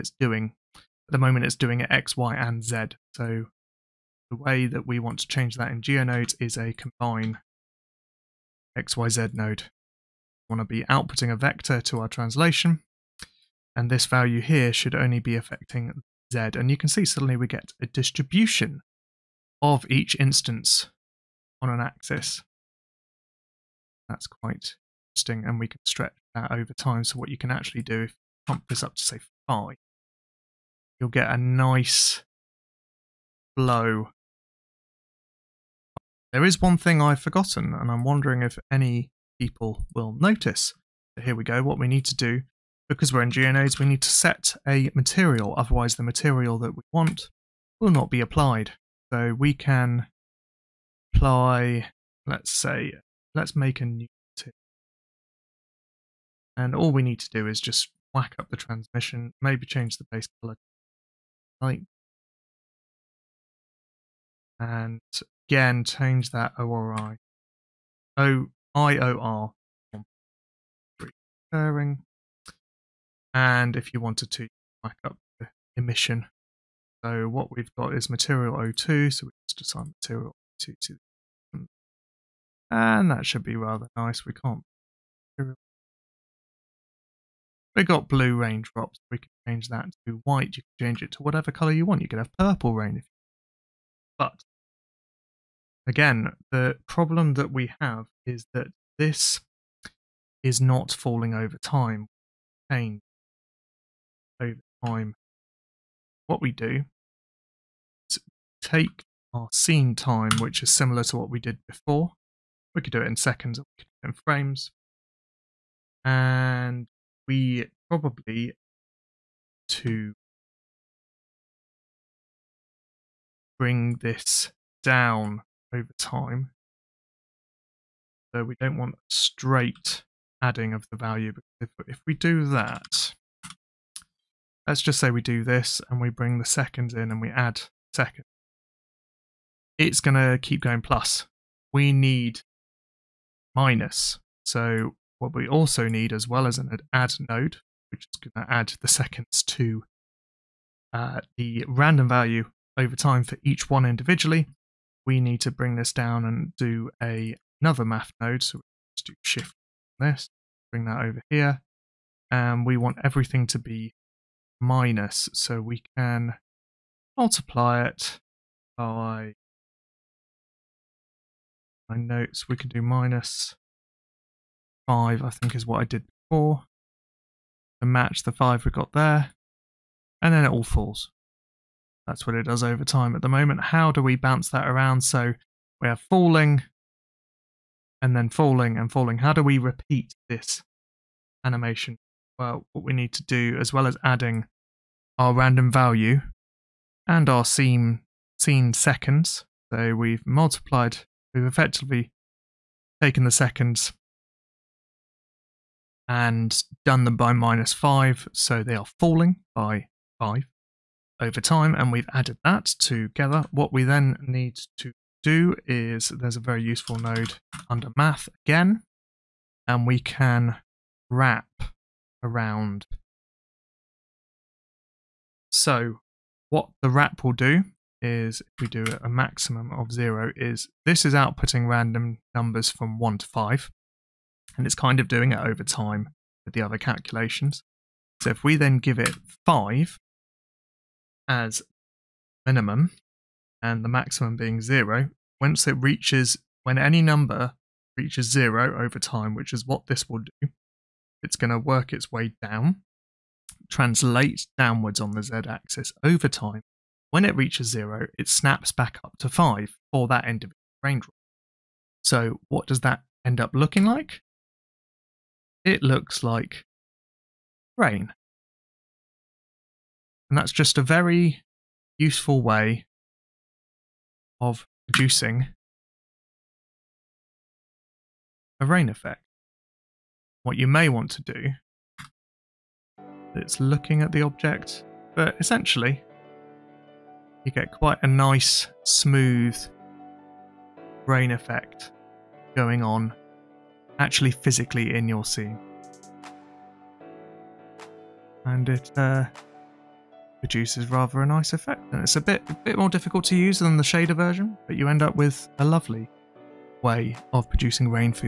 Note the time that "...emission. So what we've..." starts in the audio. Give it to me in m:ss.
1:15.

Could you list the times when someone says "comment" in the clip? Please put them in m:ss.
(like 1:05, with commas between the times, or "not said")
not said.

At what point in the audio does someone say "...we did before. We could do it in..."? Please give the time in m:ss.
1:51.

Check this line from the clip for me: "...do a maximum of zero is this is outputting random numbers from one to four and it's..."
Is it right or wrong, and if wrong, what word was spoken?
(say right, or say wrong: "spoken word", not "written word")
wrong: "five", not "four".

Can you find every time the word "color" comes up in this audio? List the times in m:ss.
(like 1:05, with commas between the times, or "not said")
1:00, 1:31.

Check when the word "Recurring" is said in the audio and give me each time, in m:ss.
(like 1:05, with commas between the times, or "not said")
1:11.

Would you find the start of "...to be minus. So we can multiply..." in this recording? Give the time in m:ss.
2:43.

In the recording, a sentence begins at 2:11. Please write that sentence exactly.
If, if we do that, let's just say we do this and we bring the seconds in and we add seconds.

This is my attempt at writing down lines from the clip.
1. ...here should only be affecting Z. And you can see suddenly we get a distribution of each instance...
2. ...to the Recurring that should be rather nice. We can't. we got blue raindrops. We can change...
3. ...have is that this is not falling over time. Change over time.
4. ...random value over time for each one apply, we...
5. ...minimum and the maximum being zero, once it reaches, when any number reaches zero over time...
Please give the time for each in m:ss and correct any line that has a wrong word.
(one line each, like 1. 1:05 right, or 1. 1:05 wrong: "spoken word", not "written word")
1. 0:14 right
2. 1:20 wrong: "And", not "Recurring"
3. 1:37 right
4. 2:31 wrong: "individually", not "apply"
5. 4:02 right.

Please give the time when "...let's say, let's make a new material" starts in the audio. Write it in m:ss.
0:52.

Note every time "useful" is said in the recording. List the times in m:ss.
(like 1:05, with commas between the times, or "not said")
3:36, 4:31.